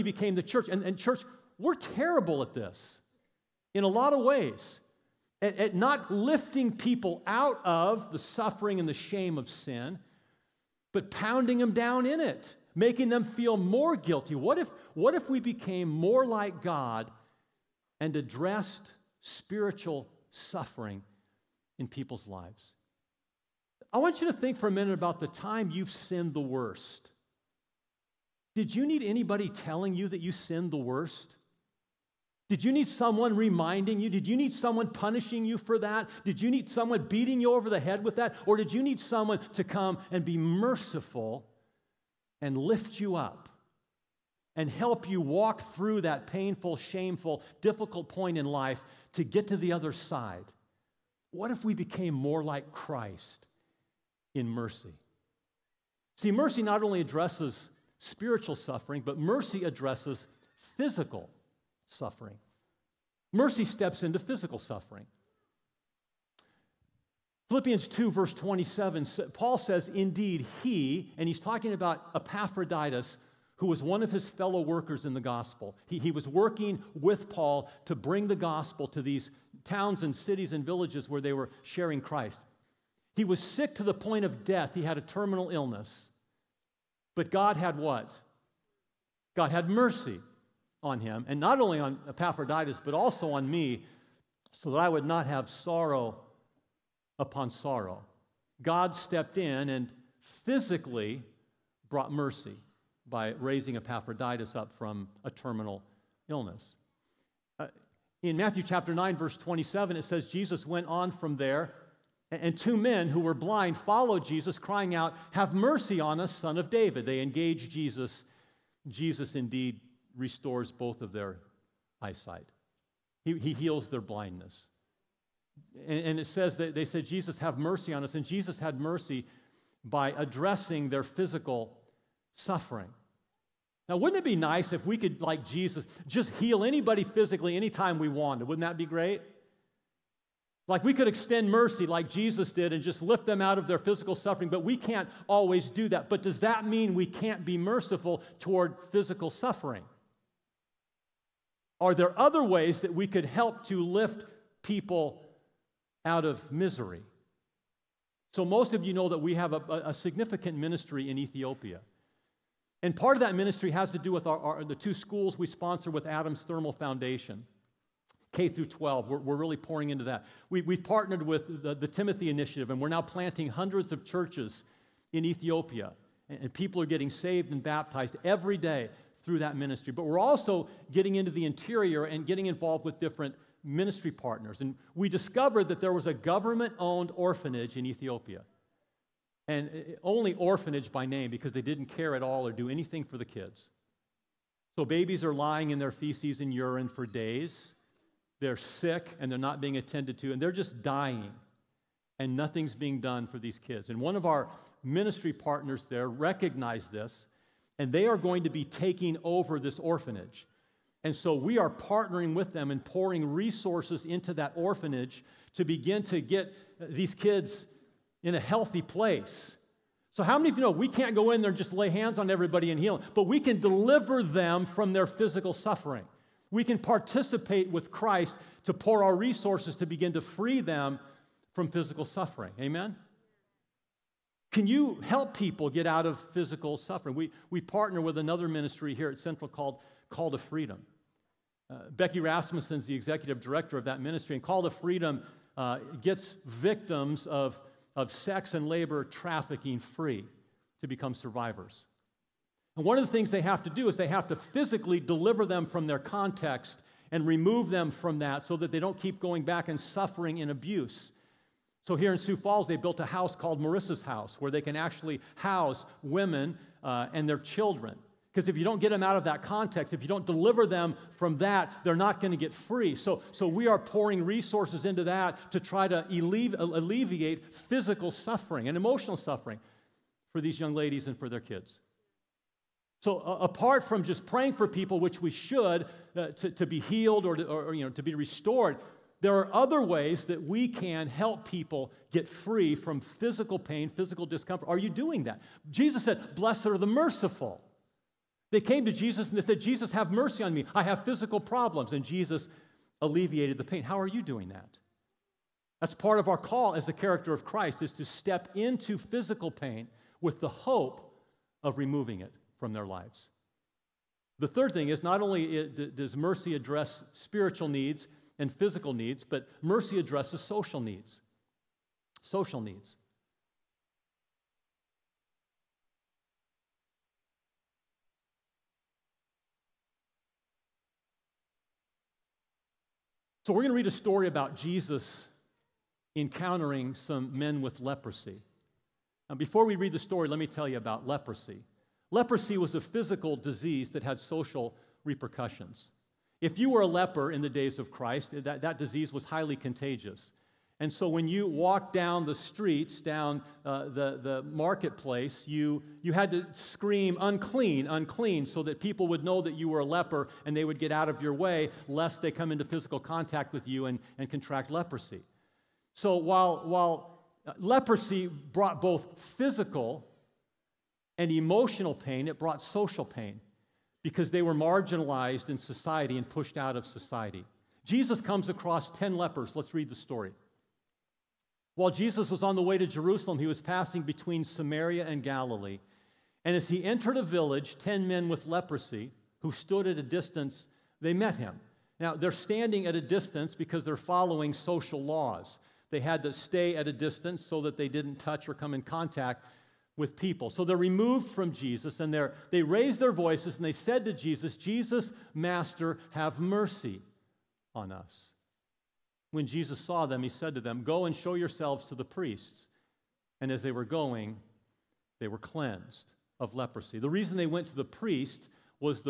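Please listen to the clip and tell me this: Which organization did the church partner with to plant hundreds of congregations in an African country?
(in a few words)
The Timothy Initiative.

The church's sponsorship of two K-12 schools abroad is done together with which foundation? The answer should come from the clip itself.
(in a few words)
Adams Thermal Foundation.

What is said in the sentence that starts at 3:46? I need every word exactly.
We can participate with Christ to pour our resources to begin to free them from physical suffering.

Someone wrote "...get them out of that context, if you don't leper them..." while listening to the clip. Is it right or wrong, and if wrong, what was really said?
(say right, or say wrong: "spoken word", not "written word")
wrong: "deliver", not "leper".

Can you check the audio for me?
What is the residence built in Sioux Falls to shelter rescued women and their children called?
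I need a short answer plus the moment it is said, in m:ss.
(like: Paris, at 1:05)
Marissa's House, at 4:23.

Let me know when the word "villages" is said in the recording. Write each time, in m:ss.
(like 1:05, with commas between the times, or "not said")
1:20, 6:27.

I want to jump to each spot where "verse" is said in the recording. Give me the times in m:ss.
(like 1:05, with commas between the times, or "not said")
1:08, 1:49.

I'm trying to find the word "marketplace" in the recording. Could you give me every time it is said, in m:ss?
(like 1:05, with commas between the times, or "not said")
5:54.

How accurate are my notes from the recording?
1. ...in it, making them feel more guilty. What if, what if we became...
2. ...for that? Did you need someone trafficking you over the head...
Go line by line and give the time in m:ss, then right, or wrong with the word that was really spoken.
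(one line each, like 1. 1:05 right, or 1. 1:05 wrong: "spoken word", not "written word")
1. 0:12 right
2. 0:35 wrong: "beating", not "trafficking".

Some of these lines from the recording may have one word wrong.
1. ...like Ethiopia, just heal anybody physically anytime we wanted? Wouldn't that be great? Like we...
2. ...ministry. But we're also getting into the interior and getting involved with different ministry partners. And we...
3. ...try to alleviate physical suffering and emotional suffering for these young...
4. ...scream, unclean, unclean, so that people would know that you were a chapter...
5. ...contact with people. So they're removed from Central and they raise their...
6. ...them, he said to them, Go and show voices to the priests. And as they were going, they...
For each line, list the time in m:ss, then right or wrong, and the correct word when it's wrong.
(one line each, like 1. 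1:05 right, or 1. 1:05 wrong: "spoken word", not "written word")
1. 2:15 wrong: "Jesus", not "Ethiopia"
2. 2:59 right
3. 4:35 right
4. 5:56 wrong: "leper", not "chapter"
5. 6:38 wrong: "Jesus", not "Central"
6. 6:50 wrong: "yourselves", not "voices".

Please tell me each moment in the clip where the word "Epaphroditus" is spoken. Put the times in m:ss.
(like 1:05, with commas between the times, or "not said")
1:12, 1:32, 1:43.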